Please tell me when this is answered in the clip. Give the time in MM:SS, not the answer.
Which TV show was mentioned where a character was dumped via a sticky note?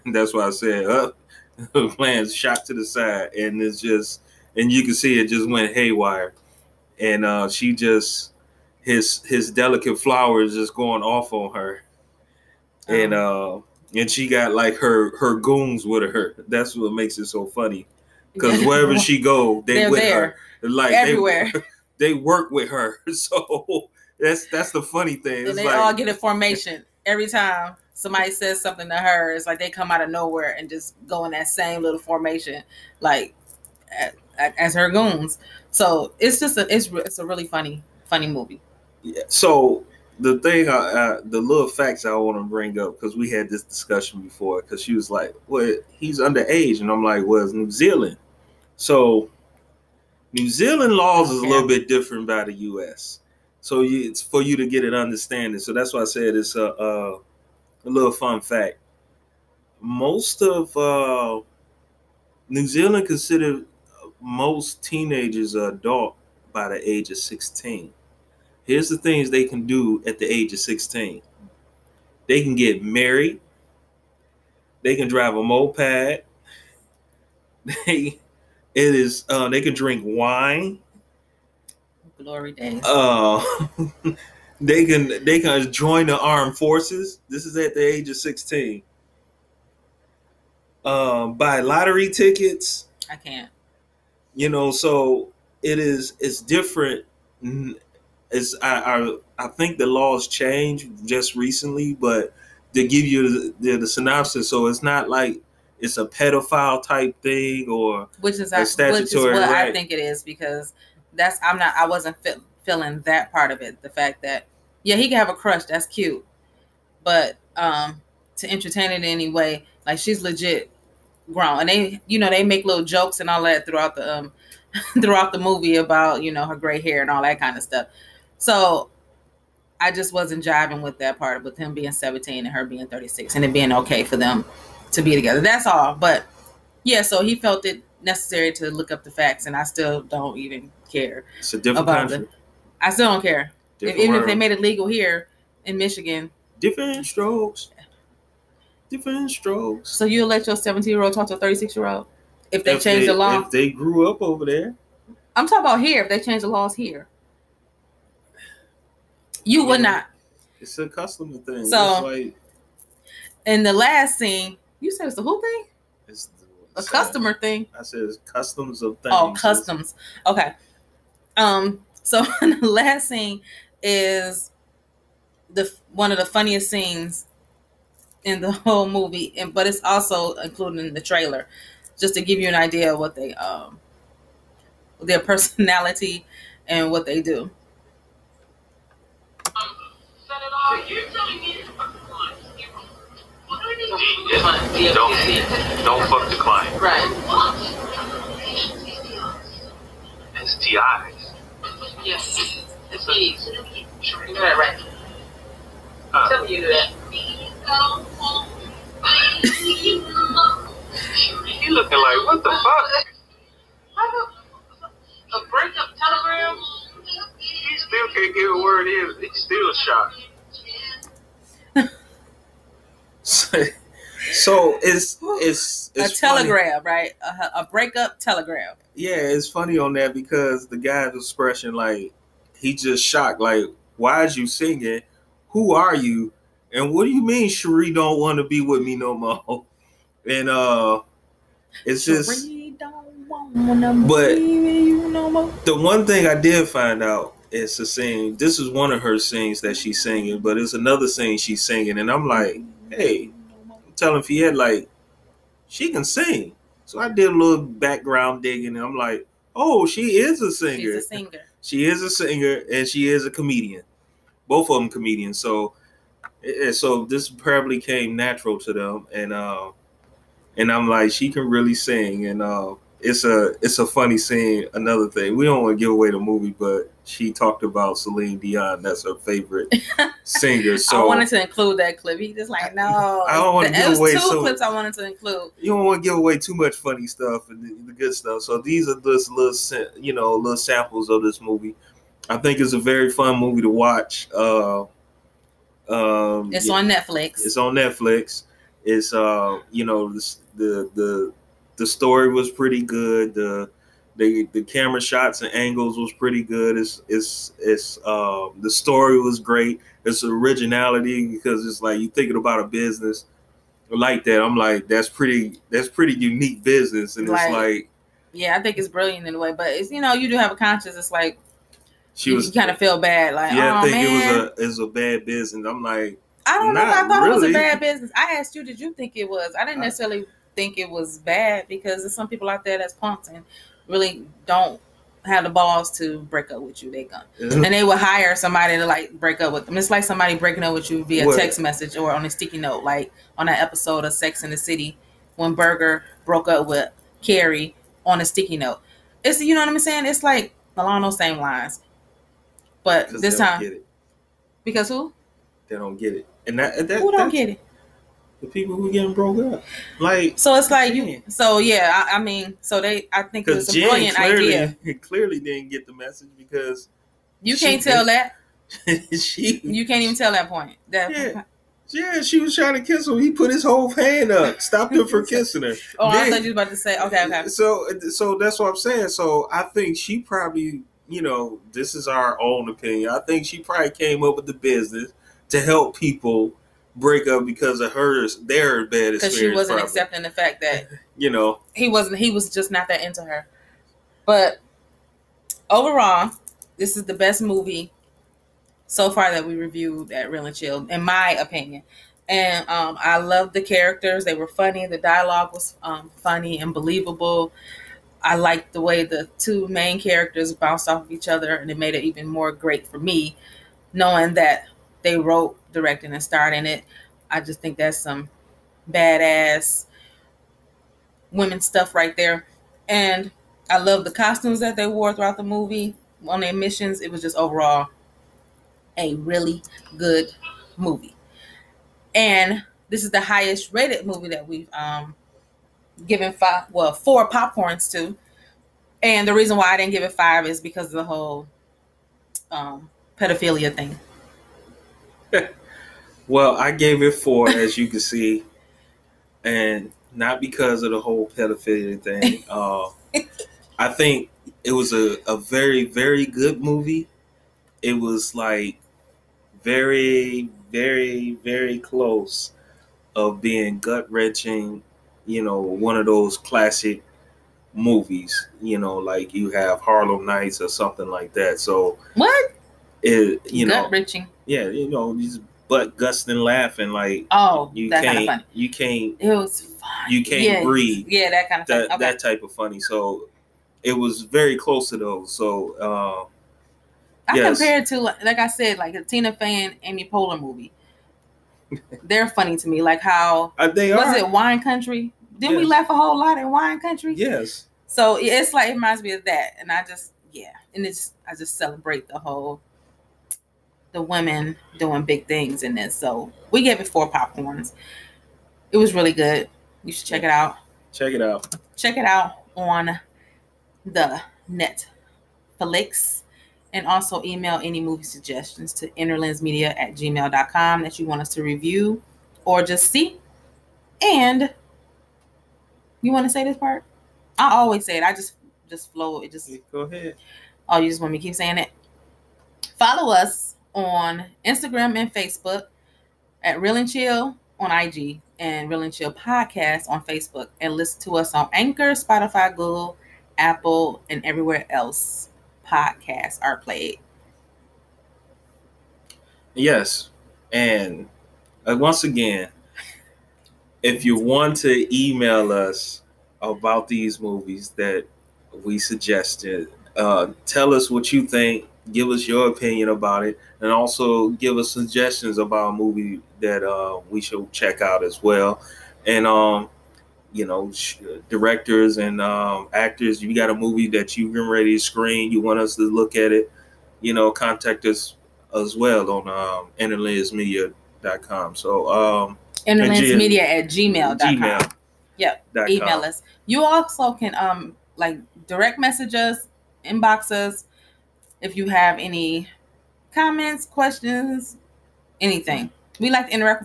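05:44.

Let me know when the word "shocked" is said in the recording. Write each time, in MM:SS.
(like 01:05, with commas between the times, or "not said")
03:41, 03:53.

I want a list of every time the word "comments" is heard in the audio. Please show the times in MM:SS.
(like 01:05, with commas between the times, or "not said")
09:53.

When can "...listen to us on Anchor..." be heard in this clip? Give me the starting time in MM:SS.
09:00.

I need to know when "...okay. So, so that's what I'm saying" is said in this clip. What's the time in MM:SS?
06:17.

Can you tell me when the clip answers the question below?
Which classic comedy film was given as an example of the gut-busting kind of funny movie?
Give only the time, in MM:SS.
07:49.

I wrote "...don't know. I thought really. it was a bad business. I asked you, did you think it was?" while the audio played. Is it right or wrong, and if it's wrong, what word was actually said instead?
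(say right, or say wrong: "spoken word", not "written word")
right.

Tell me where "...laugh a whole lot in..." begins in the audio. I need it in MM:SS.
08:15.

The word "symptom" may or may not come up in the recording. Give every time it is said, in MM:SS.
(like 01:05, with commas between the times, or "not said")
not said.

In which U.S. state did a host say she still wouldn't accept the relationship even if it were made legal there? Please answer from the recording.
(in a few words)
Michigan.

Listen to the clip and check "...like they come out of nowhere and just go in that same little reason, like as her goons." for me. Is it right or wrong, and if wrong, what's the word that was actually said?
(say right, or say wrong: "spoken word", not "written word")
wrong: "formation", not "reason".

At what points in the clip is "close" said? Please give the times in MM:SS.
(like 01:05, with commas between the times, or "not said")
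07:41, 08:04.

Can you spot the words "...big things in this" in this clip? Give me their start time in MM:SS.
08:25.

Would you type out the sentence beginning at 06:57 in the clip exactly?
I just think that's some badass women stuff right there.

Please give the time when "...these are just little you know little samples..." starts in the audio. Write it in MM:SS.
04:48.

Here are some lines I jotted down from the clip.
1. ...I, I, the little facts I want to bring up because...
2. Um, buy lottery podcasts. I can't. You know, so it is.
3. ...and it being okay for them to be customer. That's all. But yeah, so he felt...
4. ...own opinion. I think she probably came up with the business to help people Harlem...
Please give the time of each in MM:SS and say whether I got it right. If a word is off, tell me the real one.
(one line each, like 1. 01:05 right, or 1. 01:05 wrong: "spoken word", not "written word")
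1. 00:40 right
2. 01:30 wrong: "tickets", not "podcasts"
3. 02:13 wrong: "together", not "customer"
4. 06:22 wrong: "Break", not "Harlem".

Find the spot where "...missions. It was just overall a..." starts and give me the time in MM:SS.
07:06.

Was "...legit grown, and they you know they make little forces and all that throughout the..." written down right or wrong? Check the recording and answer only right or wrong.
wrong.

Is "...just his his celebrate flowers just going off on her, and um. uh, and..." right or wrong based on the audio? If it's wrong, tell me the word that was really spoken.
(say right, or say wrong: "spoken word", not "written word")
wrong: "delicate", not "celebrate".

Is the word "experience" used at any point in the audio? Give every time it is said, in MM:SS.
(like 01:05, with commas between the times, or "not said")
06:29.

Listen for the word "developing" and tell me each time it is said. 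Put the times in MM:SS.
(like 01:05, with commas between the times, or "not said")
not said.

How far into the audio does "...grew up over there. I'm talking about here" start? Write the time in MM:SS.
02:33.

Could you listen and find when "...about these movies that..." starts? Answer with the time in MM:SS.
09:16.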